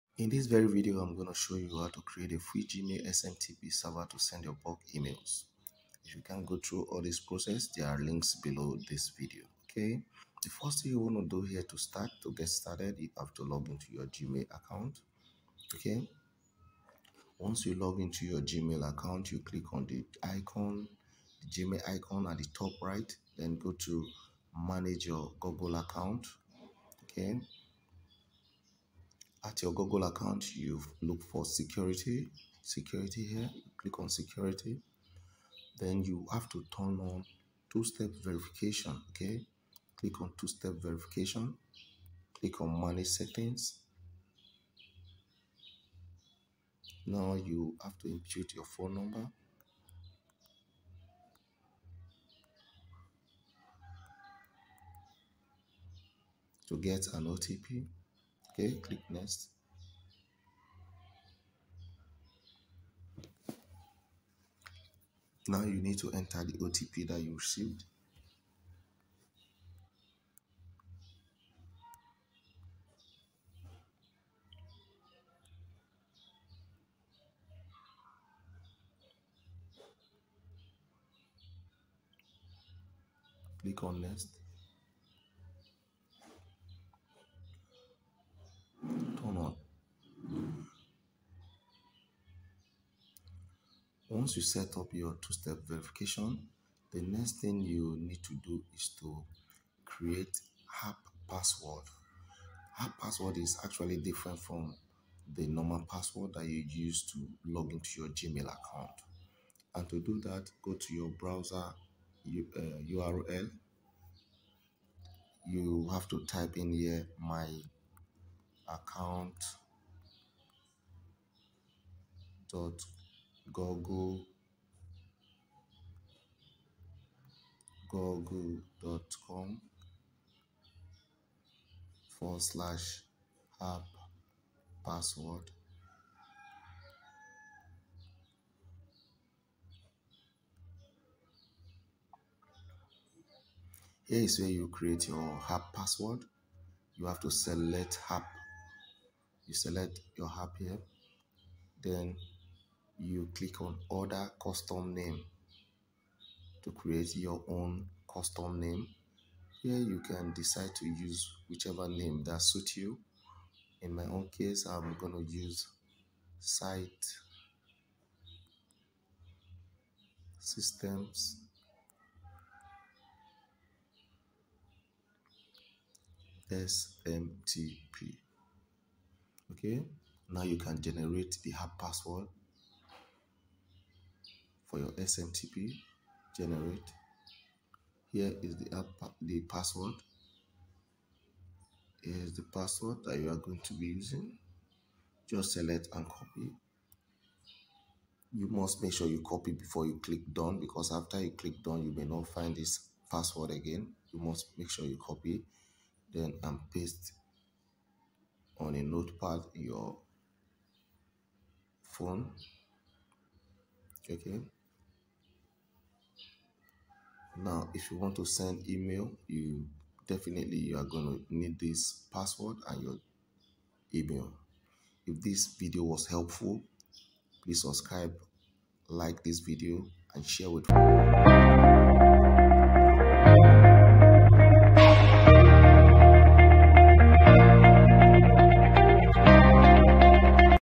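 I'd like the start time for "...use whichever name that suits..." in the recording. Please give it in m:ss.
2:40.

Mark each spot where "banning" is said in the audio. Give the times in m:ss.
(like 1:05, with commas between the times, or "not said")
not said.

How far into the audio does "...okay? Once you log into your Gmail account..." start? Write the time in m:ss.
0:15.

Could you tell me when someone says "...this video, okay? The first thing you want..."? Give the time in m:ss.
0:08.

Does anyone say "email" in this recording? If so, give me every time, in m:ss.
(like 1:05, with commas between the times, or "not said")
0:04, 3:38, 3:43.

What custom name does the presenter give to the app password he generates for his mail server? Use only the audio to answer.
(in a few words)
Site Systems SMTP.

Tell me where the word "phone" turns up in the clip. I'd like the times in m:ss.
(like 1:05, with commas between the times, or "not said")
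0:48, 3:31.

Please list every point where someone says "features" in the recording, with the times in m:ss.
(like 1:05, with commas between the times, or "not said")
not said.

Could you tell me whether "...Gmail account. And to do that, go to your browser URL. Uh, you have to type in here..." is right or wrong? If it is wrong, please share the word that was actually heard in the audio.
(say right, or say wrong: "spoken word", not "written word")
right.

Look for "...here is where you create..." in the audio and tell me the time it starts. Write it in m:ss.
2:24.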